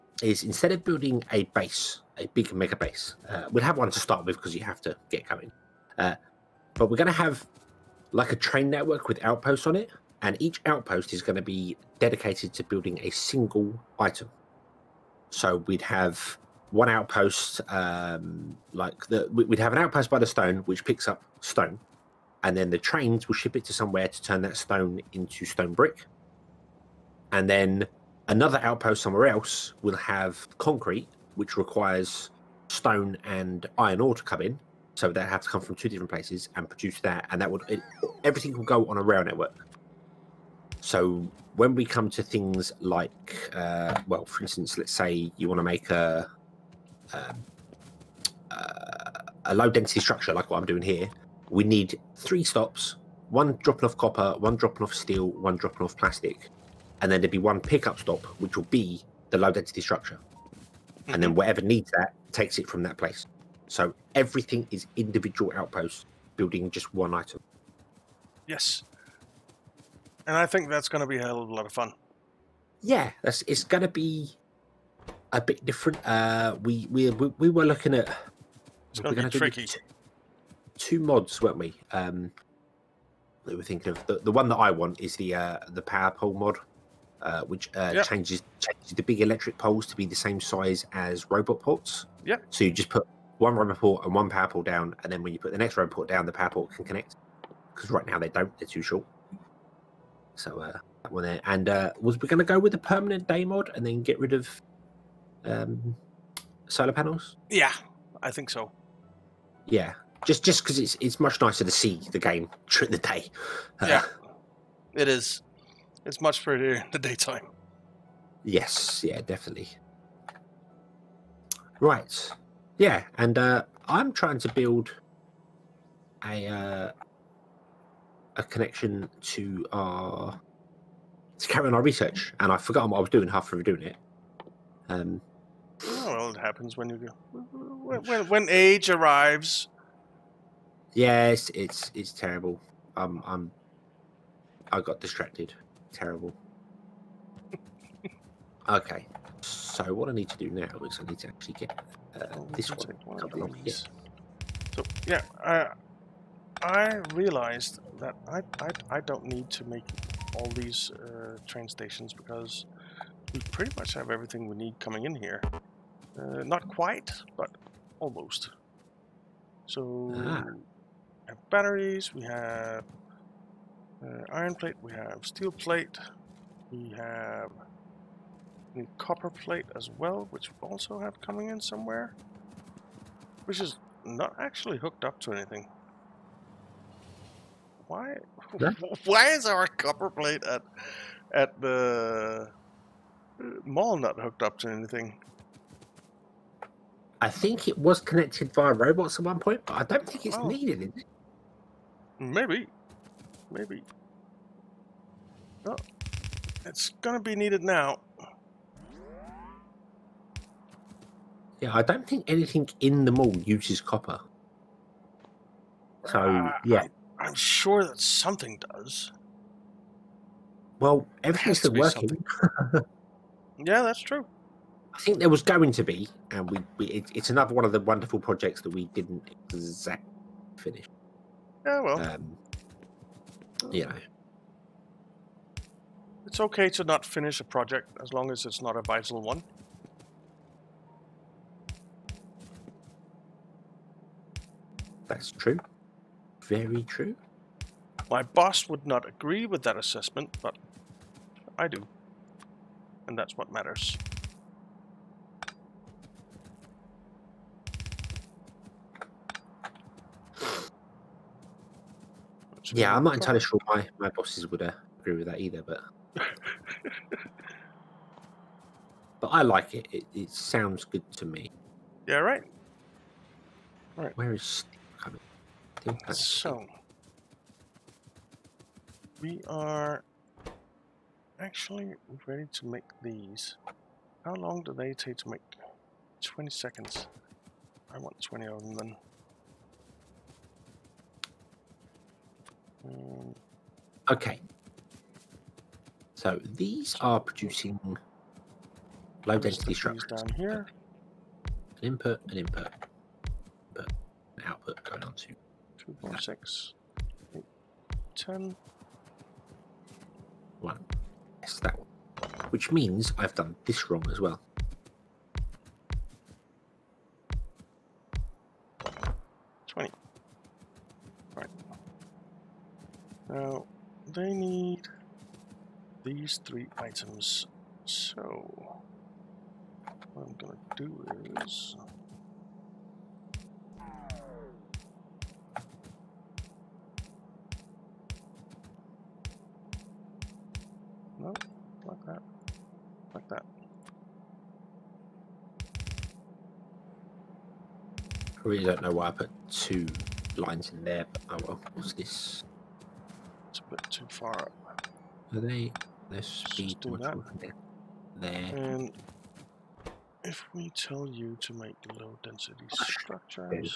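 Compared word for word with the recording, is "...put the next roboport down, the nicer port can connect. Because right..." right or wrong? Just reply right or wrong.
wrong.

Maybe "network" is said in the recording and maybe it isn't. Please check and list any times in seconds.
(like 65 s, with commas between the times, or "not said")
8 s, 39 s.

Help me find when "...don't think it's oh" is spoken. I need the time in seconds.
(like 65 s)
199 s.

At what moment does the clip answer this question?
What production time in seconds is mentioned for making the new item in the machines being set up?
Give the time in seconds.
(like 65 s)
286 s.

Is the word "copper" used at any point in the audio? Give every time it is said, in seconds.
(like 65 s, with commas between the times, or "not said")
53 s, 178 s, 189 s, 213 s.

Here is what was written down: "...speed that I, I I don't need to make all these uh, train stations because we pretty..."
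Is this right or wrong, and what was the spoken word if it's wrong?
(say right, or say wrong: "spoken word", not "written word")
wrong: "realized", not "speed".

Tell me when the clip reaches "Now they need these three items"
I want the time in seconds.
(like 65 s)
323 s.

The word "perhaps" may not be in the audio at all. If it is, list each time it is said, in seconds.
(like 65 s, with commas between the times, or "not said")
not said.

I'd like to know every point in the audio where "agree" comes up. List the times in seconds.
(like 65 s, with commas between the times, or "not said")
249 s, 265 s.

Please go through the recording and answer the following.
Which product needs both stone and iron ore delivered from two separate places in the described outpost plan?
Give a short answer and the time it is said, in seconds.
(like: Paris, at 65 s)
concrete, at 30 s.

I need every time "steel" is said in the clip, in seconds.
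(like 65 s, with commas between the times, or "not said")
54 s, 175 s.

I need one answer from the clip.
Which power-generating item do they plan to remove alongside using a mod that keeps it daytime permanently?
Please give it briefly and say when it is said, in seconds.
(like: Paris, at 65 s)
solar panels, at 106 s.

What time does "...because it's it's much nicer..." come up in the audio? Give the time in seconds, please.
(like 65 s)
110 s.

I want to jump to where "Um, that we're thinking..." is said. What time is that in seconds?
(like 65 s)
81 s.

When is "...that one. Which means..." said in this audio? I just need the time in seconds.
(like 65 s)
311 s.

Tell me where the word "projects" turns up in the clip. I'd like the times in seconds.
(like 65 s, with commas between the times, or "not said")
228 s, 237 s.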